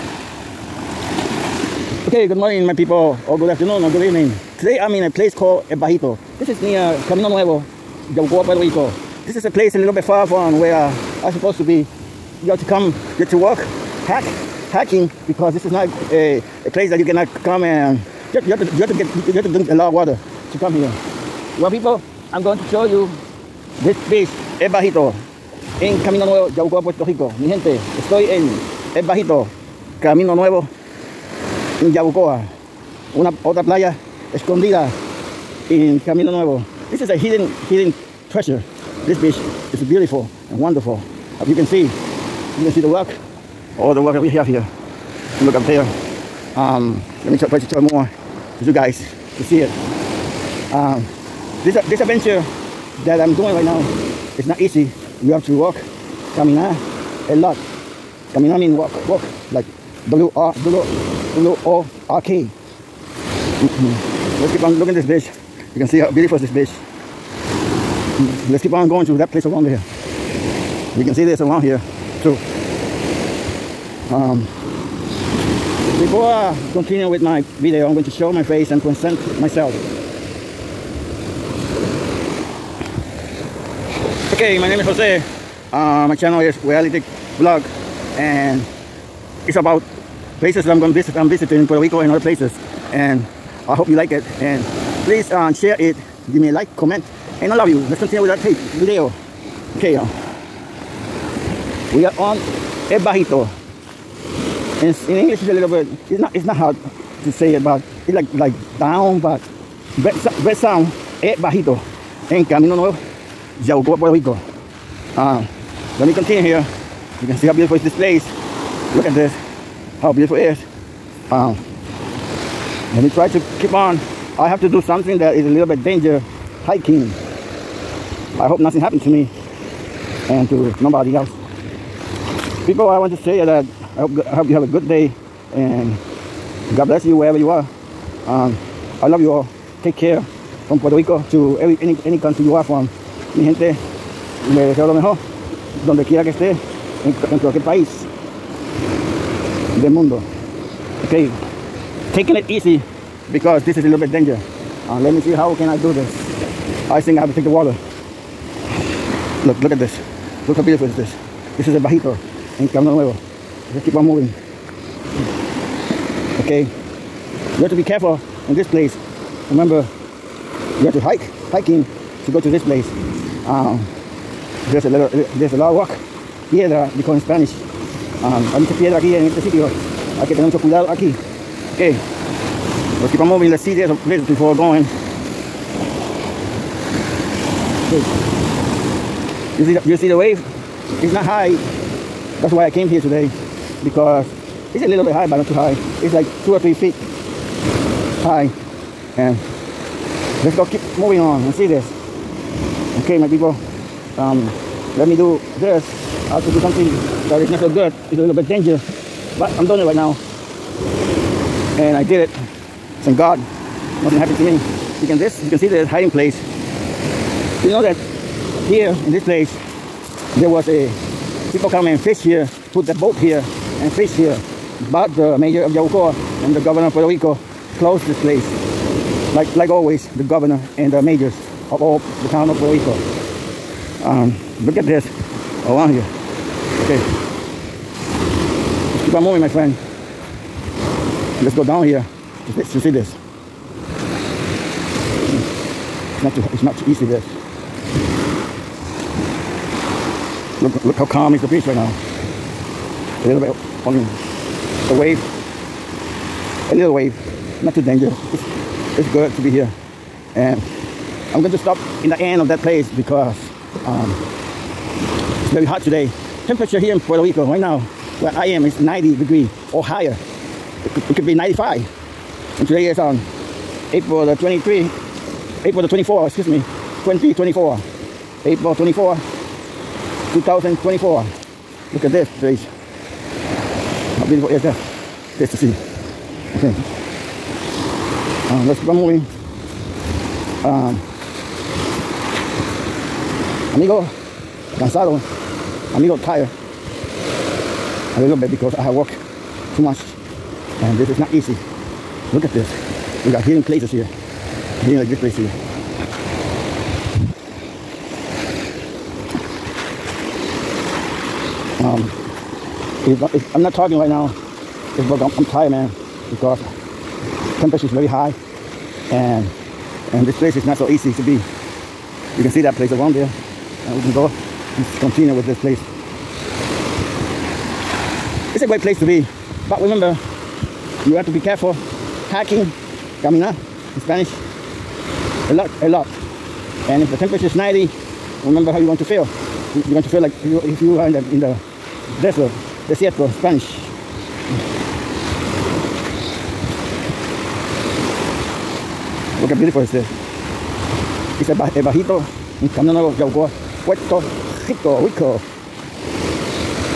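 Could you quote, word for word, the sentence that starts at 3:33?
Thank God, nothing happened to me.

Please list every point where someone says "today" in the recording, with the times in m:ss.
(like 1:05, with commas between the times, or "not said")
0:04, 3:13, 4:25, 4:32.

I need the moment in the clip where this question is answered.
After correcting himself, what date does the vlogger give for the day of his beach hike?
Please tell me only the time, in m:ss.
4:38.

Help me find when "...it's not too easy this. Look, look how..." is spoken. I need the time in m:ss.
4:06.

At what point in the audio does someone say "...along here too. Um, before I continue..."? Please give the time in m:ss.
1:11.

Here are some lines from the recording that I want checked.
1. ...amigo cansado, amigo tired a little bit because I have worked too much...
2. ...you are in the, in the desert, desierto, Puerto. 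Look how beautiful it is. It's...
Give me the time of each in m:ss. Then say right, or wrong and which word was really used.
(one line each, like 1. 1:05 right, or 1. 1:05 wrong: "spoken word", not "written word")
1. 4:53 right
2. 5:40 wrong: "Spanish", not "Puerto".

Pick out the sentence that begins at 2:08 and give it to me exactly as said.
I hope nothing happened to me and to nobody else.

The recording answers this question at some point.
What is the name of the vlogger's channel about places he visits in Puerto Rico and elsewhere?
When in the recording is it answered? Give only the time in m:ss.
1:26.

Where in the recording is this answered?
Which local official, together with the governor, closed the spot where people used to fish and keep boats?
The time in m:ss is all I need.
3:45.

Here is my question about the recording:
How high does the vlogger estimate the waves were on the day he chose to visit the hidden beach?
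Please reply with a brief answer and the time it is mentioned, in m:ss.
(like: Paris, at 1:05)
2 or 3 feet, at 3:16.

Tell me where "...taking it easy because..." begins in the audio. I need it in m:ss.
2:32.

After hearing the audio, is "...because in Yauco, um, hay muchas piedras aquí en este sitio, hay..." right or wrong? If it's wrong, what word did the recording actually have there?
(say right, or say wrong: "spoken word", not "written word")
wrong: "Spanish", not "Yauco".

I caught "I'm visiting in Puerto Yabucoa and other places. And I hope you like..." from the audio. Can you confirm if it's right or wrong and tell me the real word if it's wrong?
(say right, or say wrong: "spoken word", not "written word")
wrong: "Rico", not "Yabucoa".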